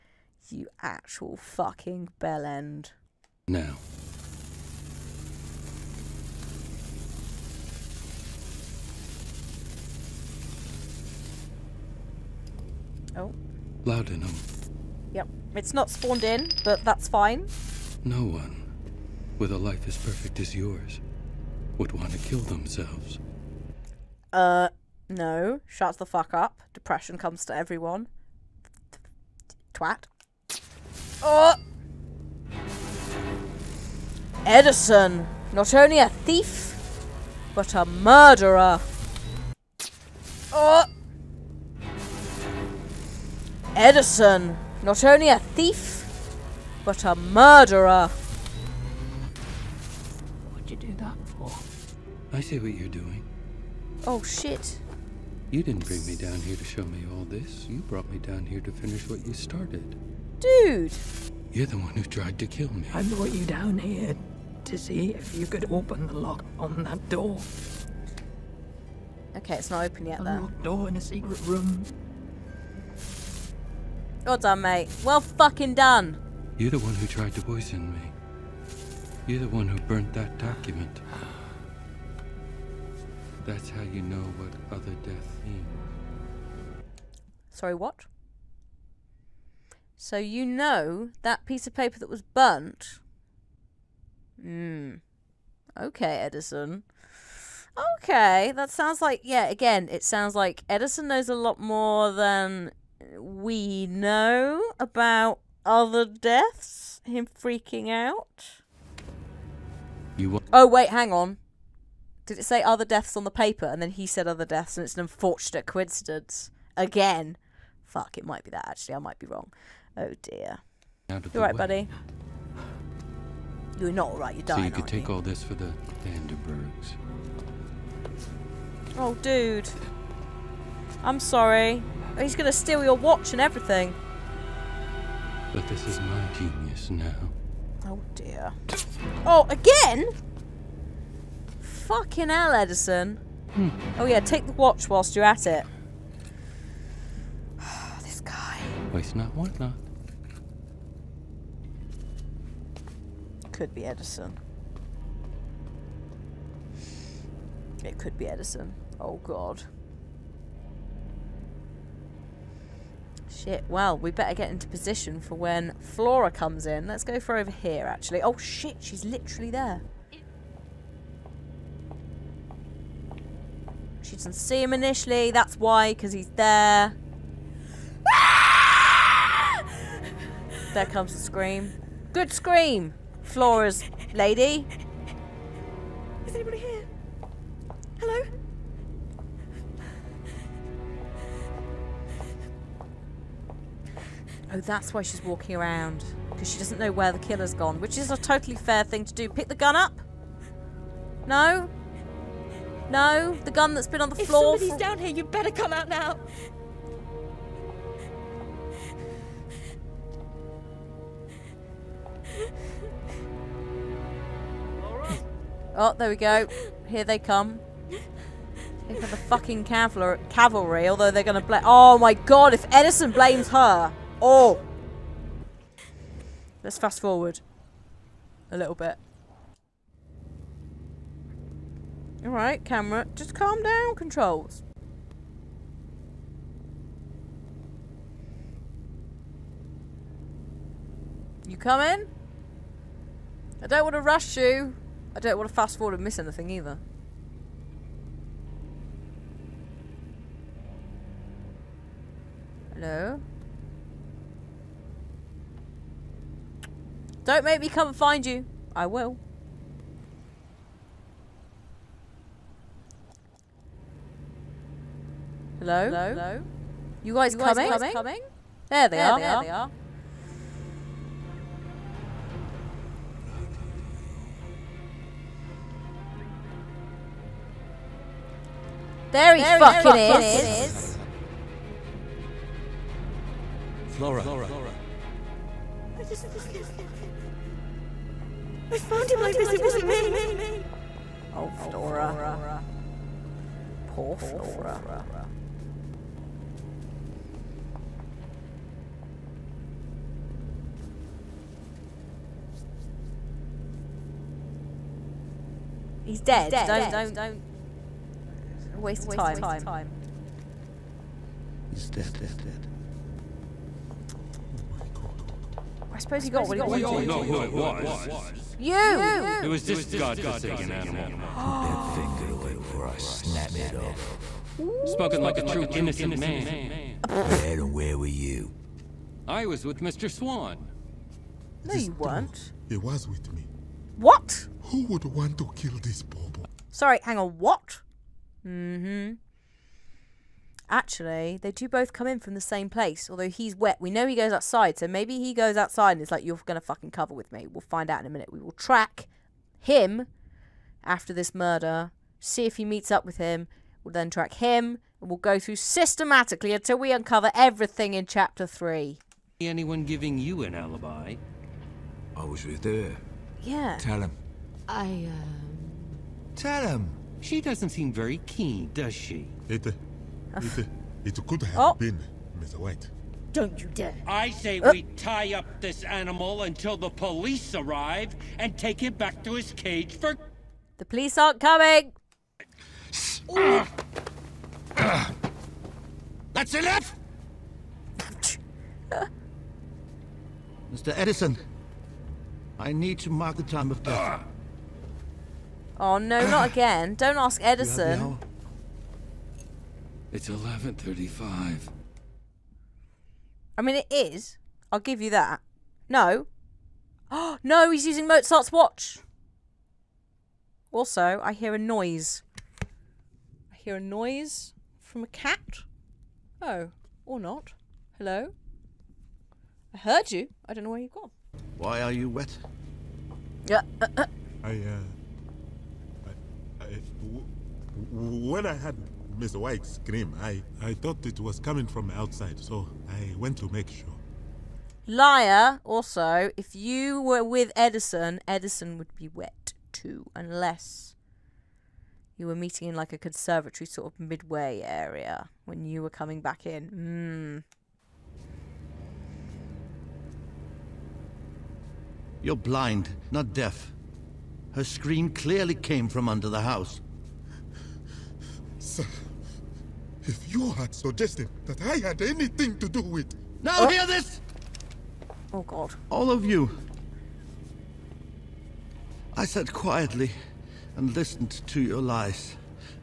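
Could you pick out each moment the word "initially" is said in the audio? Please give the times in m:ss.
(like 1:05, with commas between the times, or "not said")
2:54.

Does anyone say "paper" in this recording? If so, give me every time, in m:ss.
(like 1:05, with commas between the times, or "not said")
1:31, 1:53.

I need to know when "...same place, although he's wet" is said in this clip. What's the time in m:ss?
5:42.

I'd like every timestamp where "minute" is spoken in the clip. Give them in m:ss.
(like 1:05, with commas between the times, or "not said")
5:48.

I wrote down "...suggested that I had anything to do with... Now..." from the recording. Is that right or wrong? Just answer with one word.
right.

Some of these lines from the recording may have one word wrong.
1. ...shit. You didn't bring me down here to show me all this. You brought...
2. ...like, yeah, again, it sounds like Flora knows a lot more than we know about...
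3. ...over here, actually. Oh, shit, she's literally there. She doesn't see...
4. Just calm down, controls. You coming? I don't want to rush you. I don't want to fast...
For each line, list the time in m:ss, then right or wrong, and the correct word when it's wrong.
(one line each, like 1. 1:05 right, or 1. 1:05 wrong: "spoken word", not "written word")
1. 0:54 right
2. 1:39 wrong: "Edison", not "Flora"
3. 2:47 right
4. 3:53 right.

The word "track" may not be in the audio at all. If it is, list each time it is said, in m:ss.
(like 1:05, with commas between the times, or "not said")
5:48, 5:54.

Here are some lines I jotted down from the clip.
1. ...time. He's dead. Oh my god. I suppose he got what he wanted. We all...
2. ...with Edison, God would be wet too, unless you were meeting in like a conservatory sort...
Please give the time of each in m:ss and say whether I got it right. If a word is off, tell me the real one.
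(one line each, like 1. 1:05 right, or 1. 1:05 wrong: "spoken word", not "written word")
1. 5:09 right
2. 7:17 wrong: "Edison", not "God".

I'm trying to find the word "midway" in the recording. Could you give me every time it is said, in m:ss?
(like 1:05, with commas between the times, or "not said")
7:23.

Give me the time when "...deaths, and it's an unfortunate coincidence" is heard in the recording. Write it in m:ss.
1:54.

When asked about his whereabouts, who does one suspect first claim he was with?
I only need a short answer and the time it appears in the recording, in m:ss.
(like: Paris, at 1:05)
Mr. Swan, at 5:29.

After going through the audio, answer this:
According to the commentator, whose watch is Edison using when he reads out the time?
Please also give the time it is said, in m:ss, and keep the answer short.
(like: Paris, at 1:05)
Mozart's, at 6:48.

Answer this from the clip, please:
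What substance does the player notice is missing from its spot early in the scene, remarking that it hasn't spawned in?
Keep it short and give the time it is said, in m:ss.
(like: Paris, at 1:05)
Laudanum, at 0:13.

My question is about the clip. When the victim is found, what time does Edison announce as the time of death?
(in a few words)
11:35.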